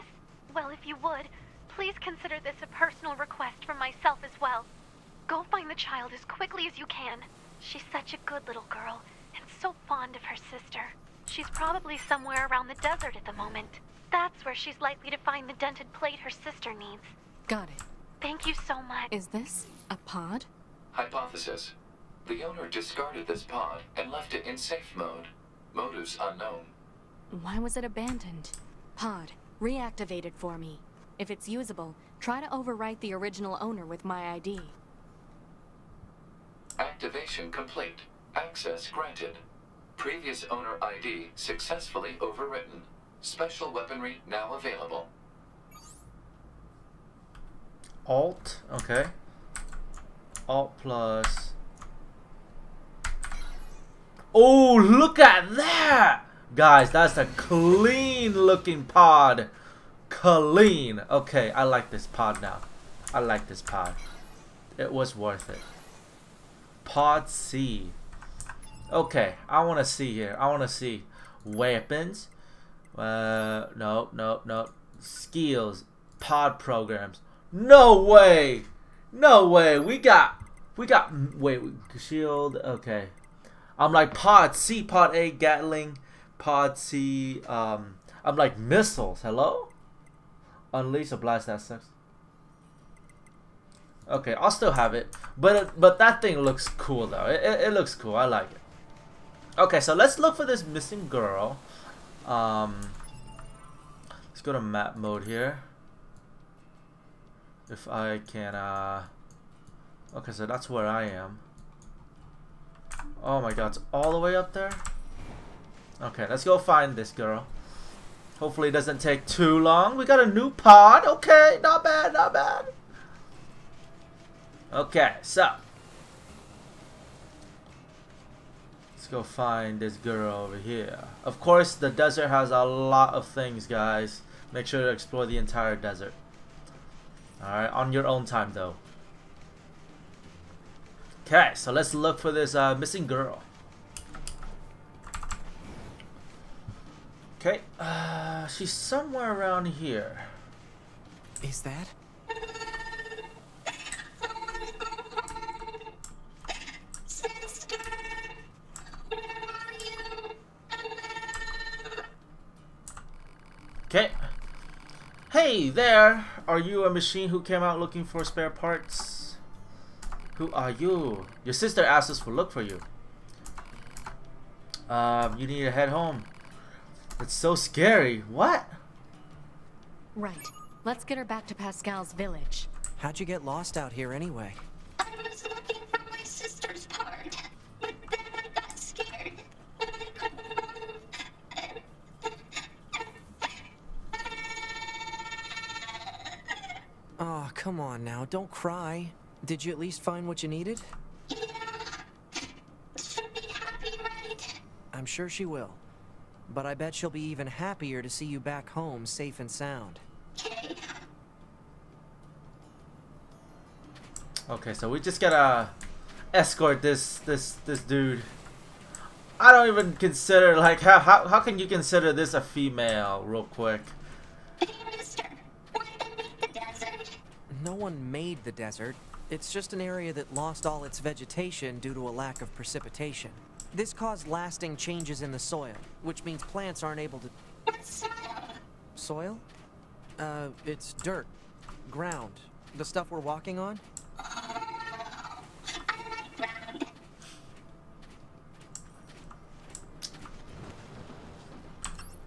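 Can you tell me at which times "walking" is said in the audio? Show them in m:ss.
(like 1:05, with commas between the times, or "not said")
4:03.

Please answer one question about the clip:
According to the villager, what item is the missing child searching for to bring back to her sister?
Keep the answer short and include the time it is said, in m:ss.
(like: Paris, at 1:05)
Dented plate, at 0:15.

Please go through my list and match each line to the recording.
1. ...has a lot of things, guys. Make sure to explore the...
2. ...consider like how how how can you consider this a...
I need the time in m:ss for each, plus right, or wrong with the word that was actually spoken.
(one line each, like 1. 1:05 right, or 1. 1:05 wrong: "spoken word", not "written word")
1. 2:12 right
2. 3:39 right.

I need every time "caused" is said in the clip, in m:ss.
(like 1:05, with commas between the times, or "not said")
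3:53.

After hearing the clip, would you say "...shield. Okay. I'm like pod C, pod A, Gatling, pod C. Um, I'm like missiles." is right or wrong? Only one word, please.
right.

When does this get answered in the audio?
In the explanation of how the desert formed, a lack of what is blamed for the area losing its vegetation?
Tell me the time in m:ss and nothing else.
3:52.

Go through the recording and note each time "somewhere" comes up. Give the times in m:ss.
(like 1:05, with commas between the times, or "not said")
0:11, 2:28.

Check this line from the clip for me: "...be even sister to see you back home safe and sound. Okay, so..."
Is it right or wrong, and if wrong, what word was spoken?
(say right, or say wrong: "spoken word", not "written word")
wrong: "happier", not "sister".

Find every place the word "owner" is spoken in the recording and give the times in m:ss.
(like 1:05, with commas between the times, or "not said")
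0:22, 0:33, 0:40.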